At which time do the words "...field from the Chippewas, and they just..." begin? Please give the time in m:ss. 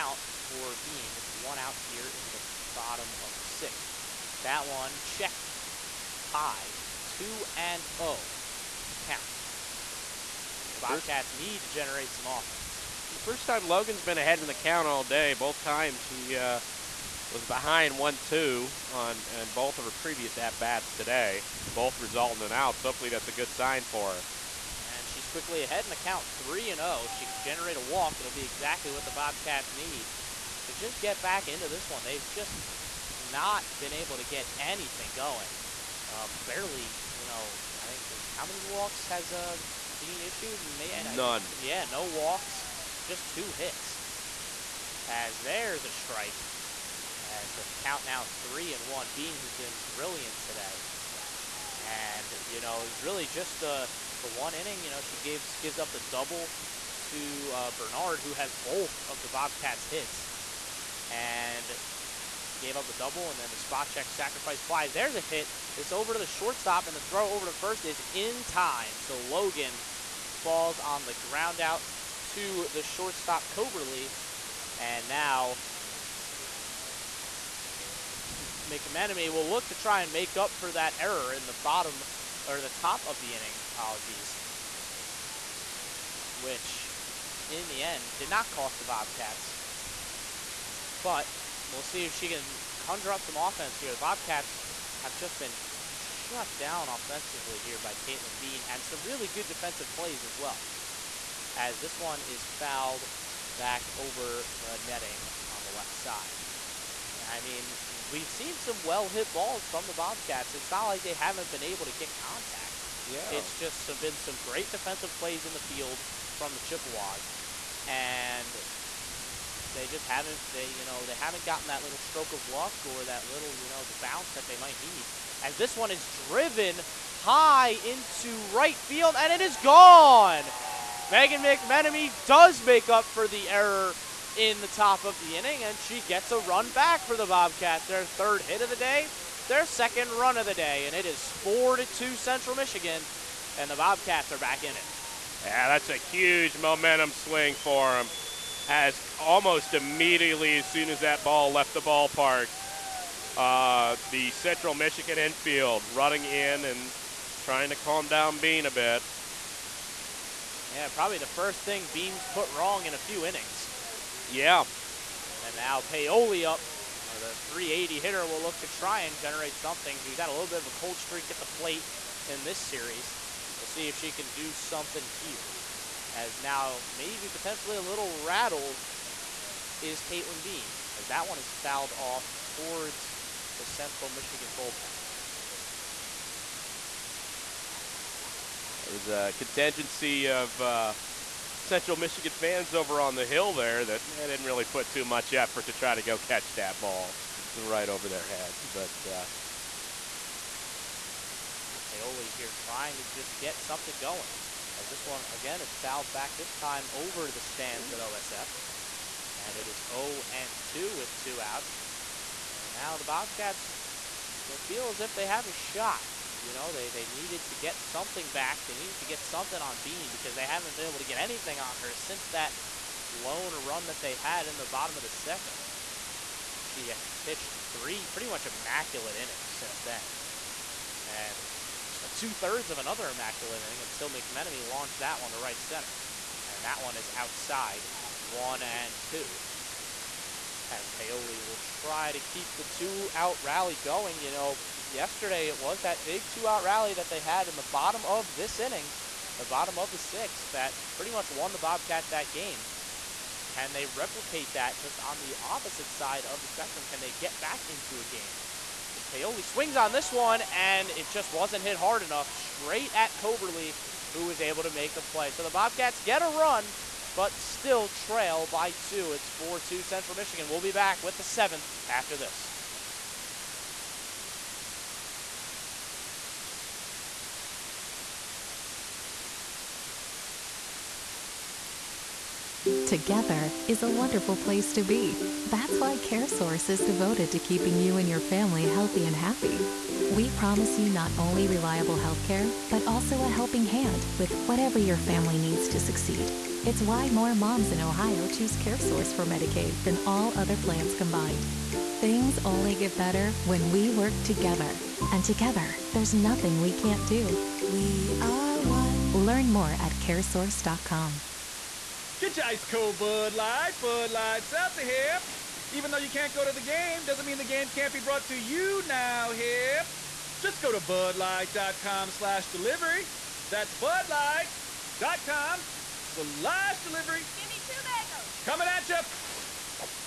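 1:55.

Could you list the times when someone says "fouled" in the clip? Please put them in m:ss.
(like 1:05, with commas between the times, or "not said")
1:42, 3:01, 3:25.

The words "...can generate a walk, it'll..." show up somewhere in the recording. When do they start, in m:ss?
0:27.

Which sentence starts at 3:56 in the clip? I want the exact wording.
And that one is outside, one and two as Paoli will try to keep the two-out rally going.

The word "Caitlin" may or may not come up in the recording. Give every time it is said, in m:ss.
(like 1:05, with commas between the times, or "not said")
1:38, 3:00.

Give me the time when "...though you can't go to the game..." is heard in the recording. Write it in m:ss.
5:15.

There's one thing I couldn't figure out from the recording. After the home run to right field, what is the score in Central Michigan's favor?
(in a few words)
4 to 2.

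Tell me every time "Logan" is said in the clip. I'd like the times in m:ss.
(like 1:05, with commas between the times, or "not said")
0:13, 1:09.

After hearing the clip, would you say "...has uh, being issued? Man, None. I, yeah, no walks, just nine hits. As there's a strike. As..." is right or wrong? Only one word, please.
wrong.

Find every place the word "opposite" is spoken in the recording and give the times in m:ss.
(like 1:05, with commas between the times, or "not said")
4:15.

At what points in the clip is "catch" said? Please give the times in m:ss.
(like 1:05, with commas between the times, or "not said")
3:16.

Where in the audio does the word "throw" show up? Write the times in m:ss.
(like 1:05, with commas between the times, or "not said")
1:06.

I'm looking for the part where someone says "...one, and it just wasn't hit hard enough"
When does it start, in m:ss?
4:20.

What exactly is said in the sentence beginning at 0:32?
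They've just not been able to get anything going.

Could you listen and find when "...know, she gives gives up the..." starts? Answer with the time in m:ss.
0:54.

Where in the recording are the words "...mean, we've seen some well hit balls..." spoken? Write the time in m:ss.
1:47.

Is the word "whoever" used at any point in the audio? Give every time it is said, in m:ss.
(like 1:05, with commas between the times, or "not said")
not said.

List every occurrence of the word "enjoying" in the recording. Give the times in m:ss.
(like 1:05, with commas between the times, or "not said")
not said.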